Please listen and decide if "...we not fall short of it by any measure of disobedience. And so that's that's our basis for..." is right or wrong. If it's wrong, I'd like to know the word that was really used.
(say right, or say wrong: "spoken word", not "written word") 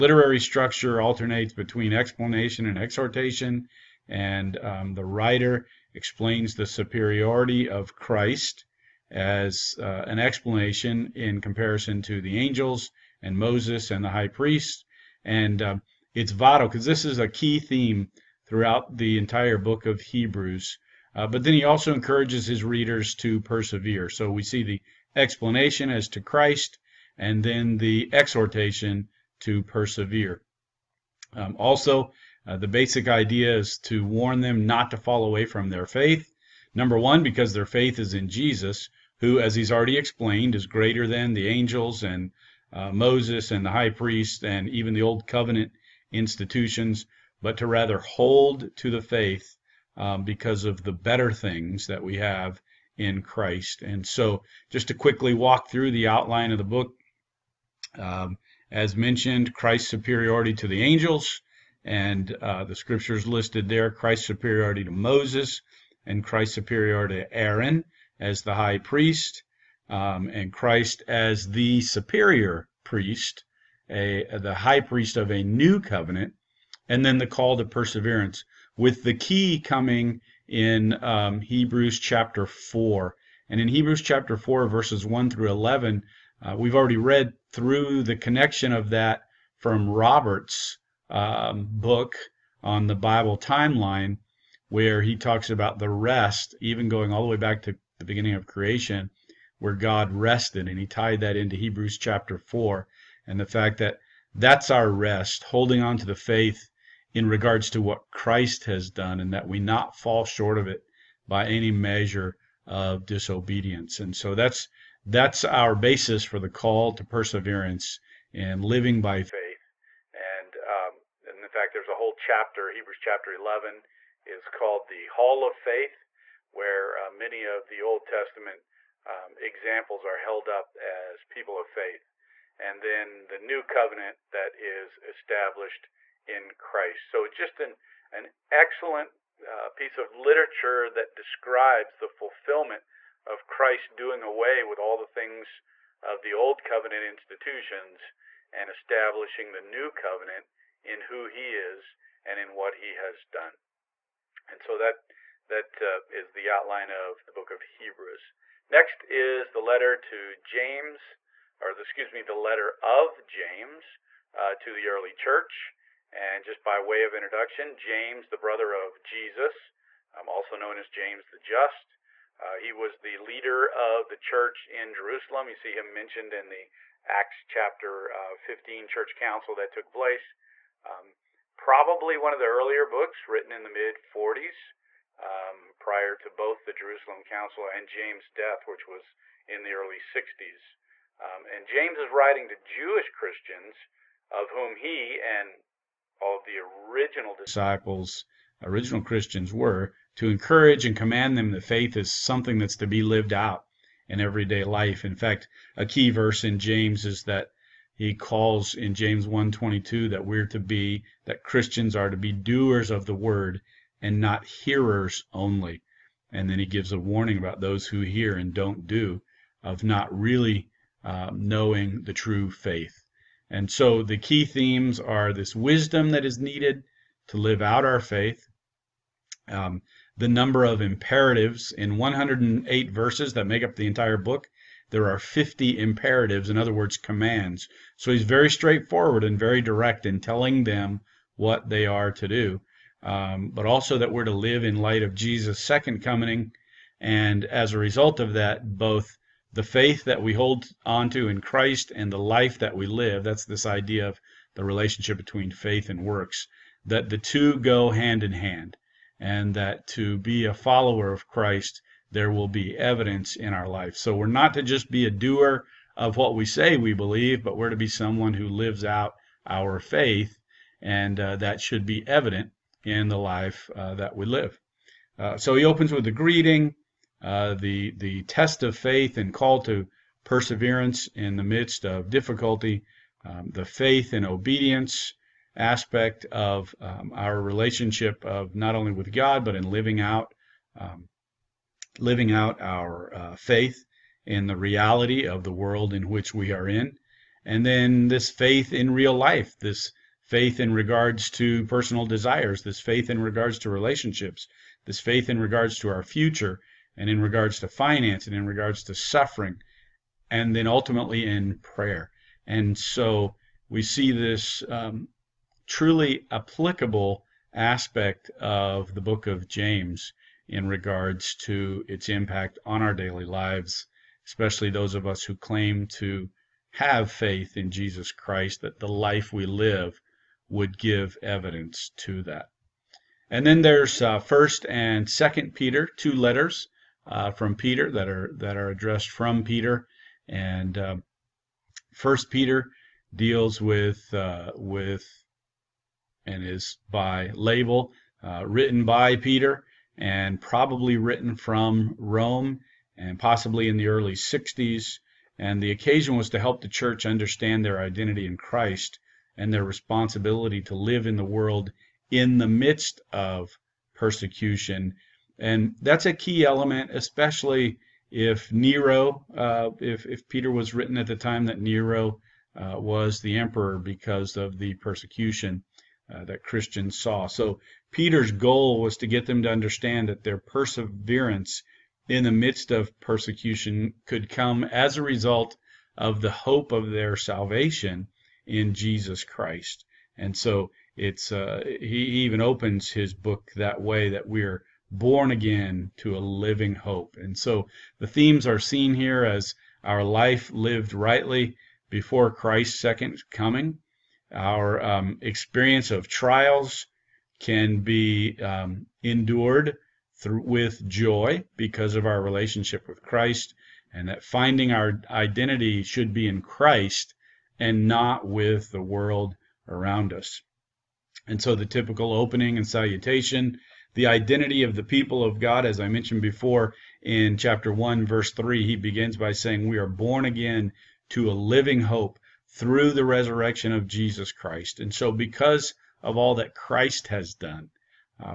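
right.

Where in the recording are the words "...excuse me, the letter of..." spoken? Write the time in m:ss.
2:41.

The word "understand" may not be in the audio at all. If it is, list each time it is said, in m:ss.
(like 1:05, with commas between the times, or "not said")
5:57, 6:19.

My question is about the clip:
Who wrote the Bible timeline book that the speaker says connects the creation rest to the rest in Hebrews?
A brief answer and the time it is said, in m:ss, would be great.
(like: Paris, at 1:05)
Robert, at 1:29.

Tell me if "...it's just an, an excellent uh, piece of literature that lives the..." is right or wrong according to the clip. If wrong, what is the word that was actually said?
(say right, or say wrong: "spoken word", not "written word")
wrong: "describes", not "lives".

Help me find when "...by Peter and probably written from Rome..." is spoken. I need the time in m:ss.
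5:48.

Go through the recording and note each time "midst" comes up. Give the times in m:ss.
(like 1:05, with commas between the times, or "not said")
4:41, 6:02, 6:22.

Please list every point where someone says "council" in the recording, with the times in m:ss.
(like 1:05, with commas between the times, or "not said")
2:59, 3:07.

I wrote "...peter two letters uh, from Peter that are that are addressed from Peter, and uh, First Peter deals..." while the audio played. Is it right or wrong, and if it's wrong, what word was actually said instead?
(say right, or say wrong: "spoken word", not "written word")
right.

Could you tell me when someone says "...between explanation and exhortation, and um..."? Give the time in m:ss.
0:01.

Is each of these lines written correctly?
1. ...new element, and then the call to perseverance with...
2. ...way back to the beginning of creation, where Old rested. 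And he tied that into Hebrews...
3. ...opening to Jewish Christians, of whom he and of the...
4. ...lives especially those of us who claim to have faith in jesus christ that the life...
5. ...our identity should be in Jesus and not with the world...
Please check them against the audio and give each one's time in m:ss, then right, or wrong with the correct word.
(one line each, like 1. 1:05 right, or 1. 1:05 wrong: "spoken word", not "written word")
1. 1:15 wrong: "covenant", not "element"
2. 1:37 wrong: "God", not "Old"
3. 3:12 wrong: "writing", not "opening"
4. 5:23 right
5. 6:54 wrong: "Christ", not "Jesus".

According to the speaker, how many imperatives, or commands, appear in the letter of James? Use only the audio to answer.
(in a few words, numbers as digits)
50.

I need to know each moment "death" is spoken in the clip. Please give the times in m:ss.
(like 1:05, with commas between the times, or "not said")
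3:08.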